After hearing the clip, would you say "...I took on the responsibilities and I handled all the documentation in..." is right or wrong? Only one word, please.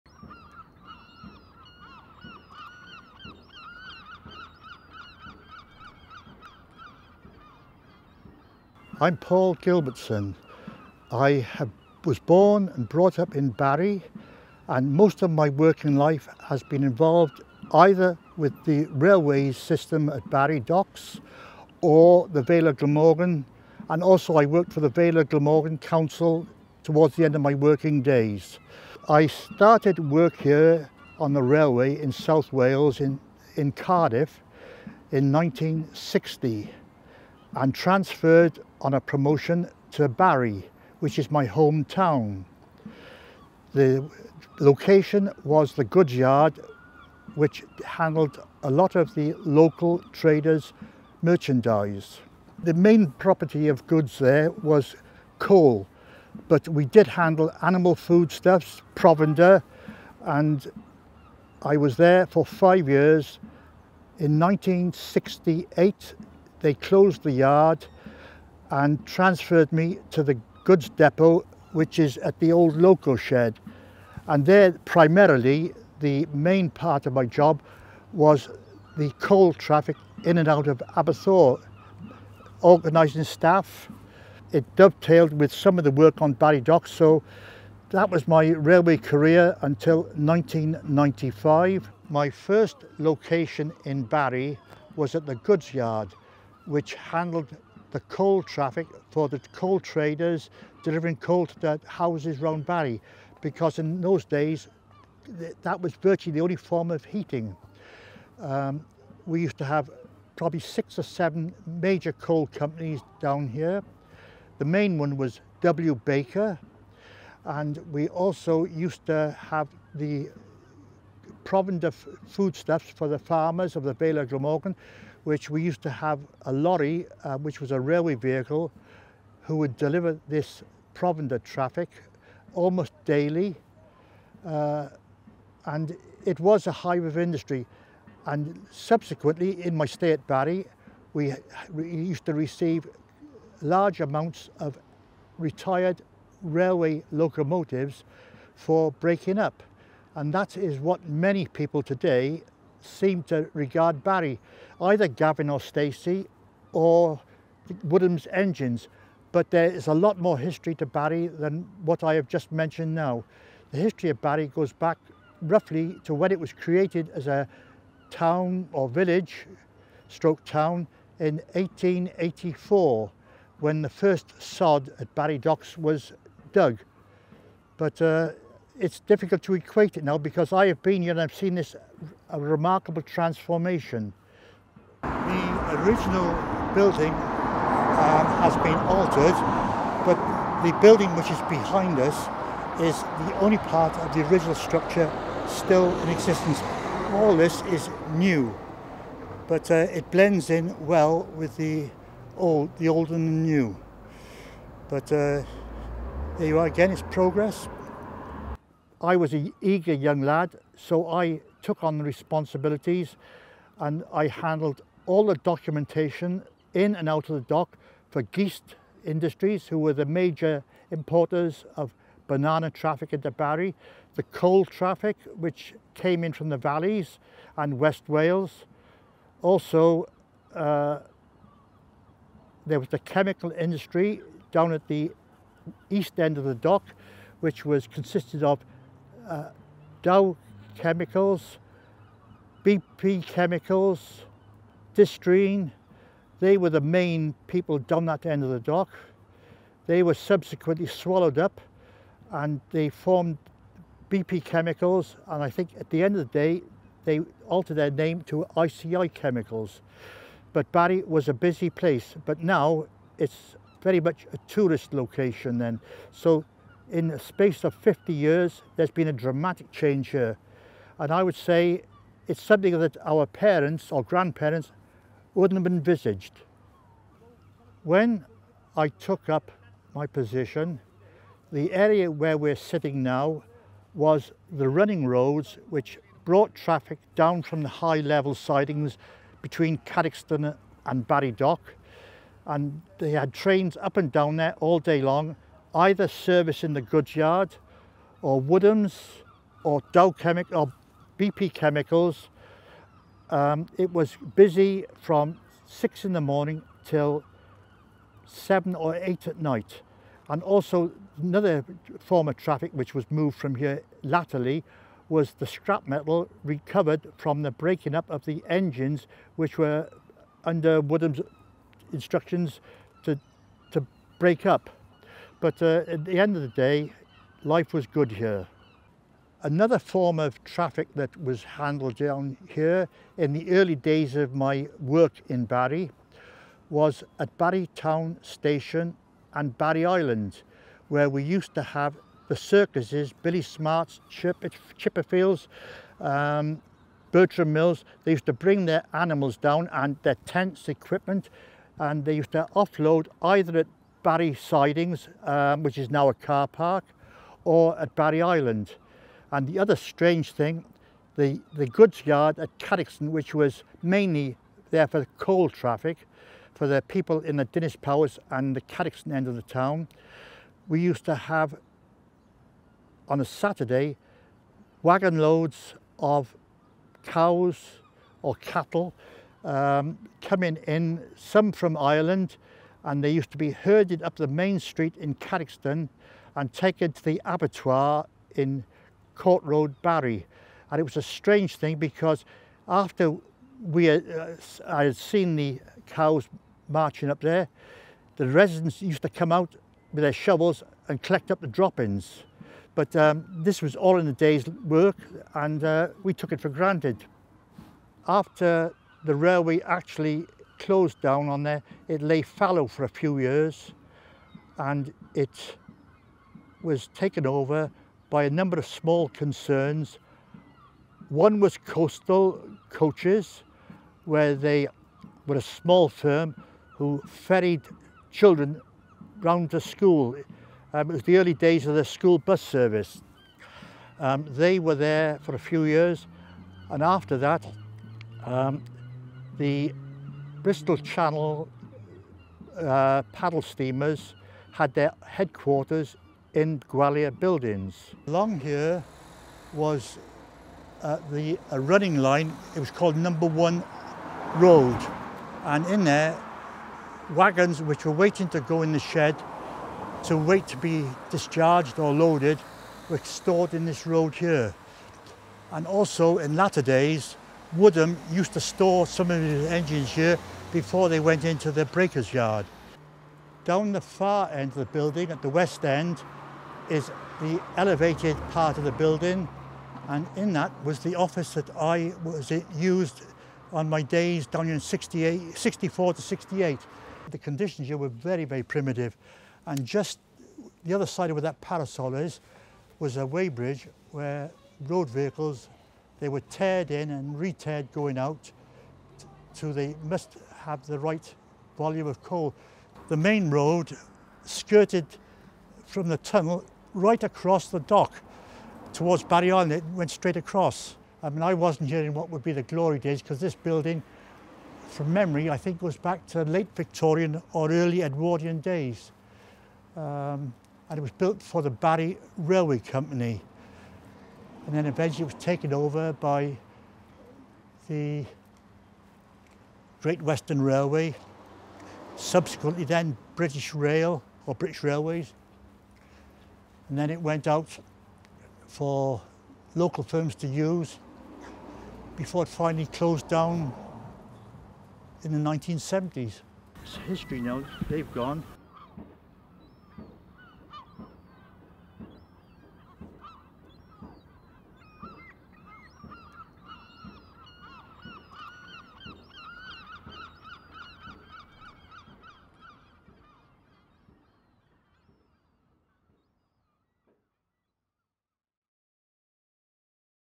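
right.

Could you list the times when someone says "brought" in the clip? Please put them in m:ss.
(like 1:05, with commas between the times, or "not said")
0:12, 4:46.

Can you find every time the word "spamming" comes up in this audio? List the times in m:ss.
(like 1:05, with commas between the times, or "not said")
not said.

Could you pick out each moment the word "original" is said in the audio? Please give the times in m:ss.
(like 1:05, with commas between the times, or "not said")
3:05, 3:14.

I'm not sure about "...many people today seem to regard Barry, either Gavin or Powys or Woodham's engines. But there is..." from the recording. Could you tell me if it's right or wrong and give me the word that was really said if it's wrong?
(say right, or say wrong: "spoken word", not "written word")
wrong: "Stacey", not "Powys".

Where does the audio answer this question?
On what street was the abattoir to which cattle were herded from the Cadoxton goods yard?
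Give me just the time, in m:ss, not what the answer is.
6:29.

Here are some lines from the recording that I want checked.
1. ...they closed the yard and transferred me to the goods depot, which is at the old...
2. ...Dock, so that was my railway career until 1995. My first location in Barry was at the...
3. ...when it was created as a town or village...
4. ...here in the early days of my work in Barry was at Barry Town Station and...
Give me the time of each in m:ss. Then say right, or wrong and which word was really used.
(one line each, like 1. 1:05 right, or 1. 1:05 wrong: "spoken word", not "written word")
1. 1:06 right
2. 1:26 right
3. 2:46 right
4. 5:32 right.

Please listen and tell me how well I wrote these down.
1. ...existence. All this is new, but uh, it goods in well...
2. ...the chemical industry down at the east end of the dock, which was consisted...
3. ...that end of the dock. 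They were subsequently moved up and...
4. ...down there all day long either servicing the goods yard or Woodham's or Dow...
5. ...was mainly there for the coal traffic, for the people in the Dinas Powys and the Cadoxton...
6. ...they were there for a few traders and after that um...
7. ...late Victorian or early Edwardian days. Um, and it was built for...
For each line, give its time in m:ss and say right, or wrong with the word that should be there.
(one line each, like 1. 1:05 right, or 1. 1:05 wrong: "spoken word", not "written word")
1. 3:16 wrong: "blends", not "goods"
2. 3:52 right
3. 4:08 wrong: "swallowed", not "moved"
4. 4:54 right
5. 6:03 right
6. 7:14 wrong: "years", not "traders"
7. 8:36 right.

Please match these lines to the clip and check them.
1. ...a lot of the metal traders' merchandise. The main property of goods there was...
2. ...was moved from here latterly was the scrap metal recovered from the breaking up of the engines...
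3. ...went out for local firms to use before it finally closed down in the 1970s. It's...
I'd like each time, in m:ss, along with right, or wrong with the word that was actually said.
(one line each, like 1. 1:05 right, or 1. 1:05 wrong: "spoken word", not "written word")
1. 0:48 wrong: "local", not "metal"
2. 5:12 right
3. 8:57 right.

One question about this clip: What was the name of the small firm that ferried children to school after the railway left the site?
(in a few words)
Coastal Coaches.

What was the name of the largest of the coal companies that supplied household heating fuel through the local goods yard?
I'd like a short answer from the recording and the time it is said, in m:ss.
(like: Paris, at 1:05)
W. Baker, at 1:55.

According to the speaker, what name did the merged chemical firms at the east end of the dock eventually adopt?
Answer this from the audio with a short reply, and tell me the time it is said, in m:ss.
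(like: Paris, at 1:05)
ICI Chemicals, at 4:18.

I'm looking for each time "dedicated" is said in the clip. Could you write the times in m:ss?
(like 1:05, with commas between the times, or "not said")
not said.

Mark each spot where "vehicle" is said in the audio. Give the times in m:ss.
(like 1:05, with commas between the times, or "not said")
2:08, 8:14.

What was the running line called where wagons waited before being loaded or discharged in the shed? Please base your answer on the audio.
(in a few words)
Number One Road.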